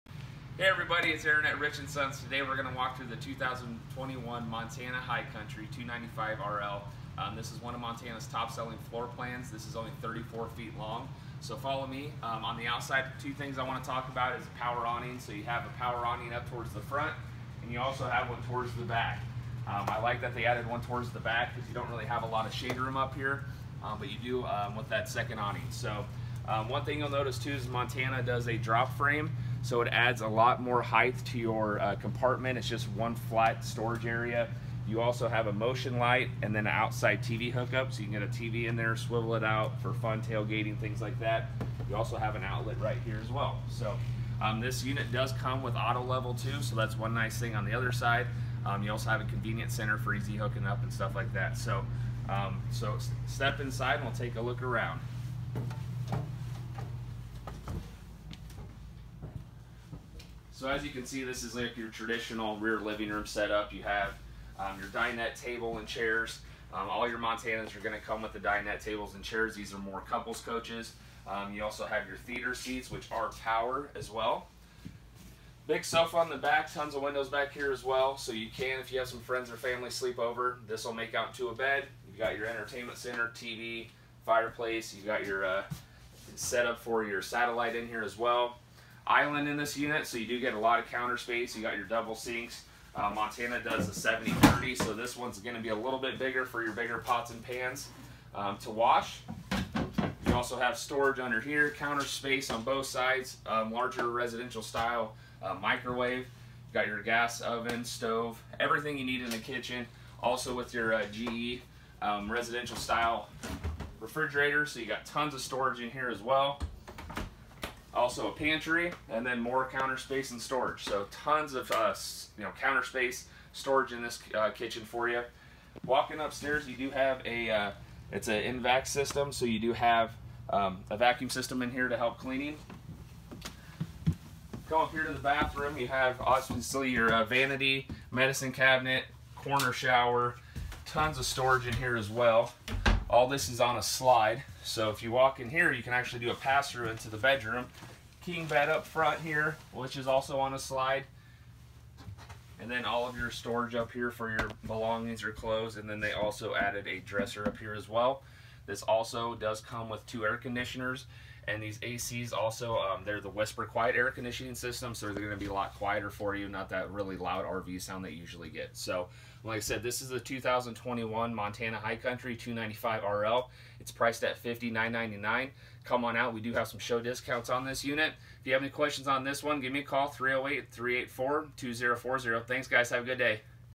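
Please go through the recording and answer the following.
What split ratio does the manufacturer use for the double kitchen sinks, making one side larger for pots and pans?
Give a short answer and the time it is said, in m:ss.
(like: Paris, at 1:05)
70-30, at 1:34.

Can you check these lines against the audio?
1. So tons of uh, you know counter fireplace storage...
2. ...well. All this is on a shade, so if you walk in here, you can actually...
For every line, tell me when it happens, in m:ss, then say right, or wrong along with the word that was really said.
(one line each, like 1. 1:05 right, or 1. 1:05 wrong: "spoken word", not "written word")
1. 2:00 wrong: "space", not "fireplace"
2. 2:22 wrong: "slide", not "shade".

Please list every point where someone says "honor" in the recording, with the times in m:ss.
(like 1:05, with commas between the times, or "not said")
not said.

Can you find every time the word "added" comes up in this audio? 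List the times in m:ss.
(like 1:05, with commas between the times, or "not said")
0:20, 2:36.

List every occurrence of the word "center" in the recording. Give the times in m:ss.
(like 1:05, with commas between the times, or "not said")
0:49, 1:22.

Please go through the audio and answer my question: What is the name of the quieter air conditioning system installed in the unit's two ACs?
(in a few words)
Whisper Quiet.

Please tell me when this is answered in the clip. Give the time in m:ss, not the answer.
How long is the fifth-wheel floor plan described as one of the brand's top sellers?
0:10.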